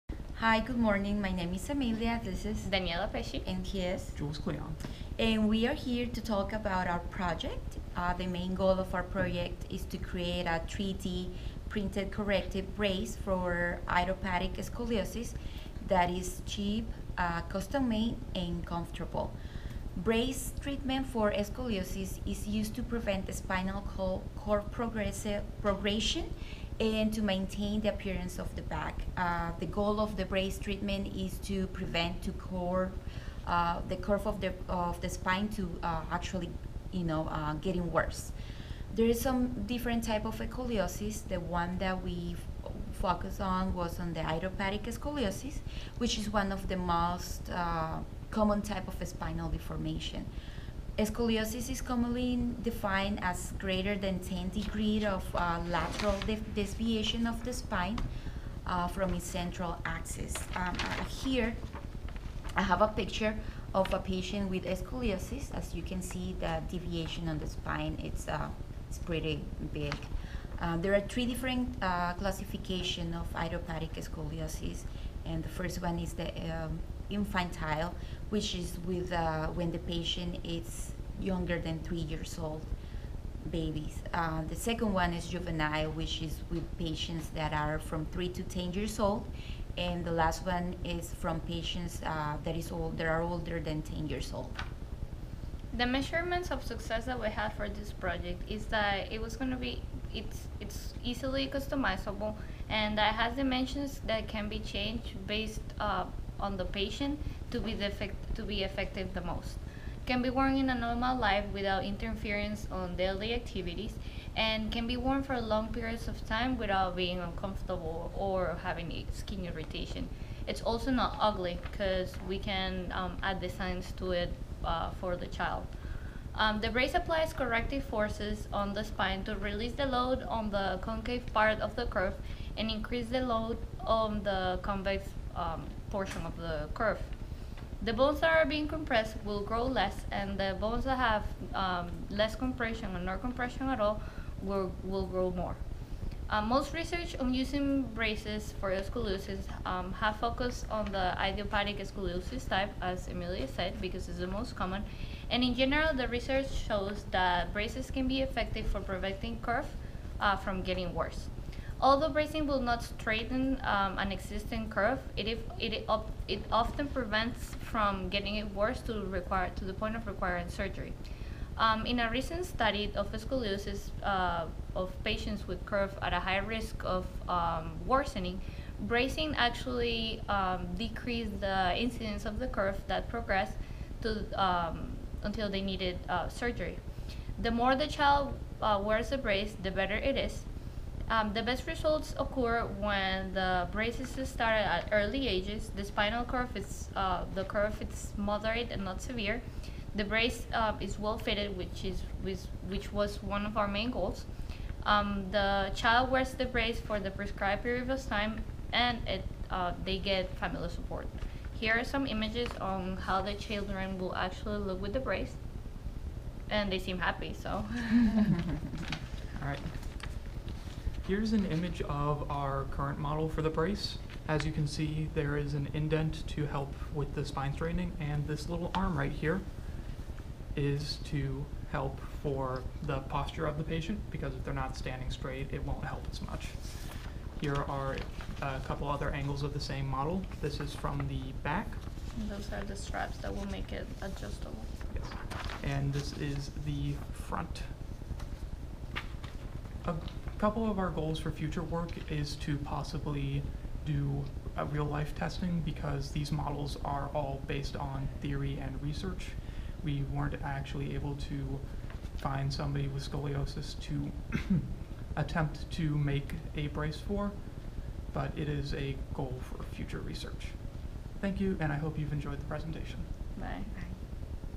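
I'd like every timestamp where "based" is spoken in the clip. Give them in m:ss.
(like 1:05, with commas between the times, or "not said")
1:45, 4:17.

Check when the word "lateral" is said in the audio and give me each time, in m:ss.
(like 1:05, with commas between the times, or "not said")
0:55.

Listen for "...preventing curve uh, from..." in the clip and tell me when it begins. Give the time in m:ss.
2:38.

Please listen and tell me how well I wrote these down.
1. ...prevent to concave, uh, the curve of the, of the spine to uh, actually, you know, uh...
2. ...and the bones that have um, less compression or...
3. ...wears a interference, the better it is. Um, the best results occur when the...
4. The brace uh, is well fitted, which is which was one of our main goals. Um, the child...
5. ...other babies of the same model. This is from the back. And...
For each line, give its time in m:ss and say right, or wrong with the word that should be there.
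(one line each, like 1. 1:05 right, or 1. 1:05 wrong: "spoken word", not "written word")
1. 0:31 wrong: "curve", not "concave"
2. 2:20 right
3. 3:08 wrong: "brace", not "interference"
4. 3:19 right
5. 3:58 wrong: "angles", not "babies".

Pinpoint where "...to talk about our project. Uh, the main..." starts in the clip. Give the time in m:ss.
0:06.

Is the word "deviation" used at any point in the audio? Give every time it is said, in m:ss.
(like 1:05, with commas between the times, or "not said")
0:56, 1:06.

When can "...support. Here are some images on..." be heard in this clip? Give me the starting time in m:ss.
3:30.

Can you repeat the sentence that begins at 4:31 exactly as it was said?
Thank you, and I hope you've enjoyed the presentation.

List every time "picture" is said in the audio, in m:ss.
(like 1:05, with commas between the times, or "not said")
1:02.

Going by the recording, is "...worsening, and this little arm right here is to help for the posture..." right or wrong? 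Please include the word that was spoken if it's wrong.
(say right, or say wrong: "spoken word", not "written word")
wrong: "straightening", not "worsening".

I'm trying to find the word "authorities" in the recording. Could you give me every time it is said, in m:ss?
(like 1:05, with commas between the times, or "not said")
not said.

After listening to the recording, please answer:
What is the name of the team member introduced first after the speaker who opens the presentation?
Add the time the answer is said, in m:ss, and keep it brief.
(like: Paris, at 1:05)
Daniela Pesci, at 0:02.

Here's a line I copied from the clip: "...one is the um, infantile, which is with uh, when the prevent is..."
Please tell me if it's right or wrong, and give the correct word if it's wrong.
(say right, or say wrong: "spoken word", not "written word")
wrong: "patient", not "prevent".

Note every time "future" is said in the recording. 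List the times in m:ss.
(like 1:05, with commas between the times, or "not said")
4:11, 4:29.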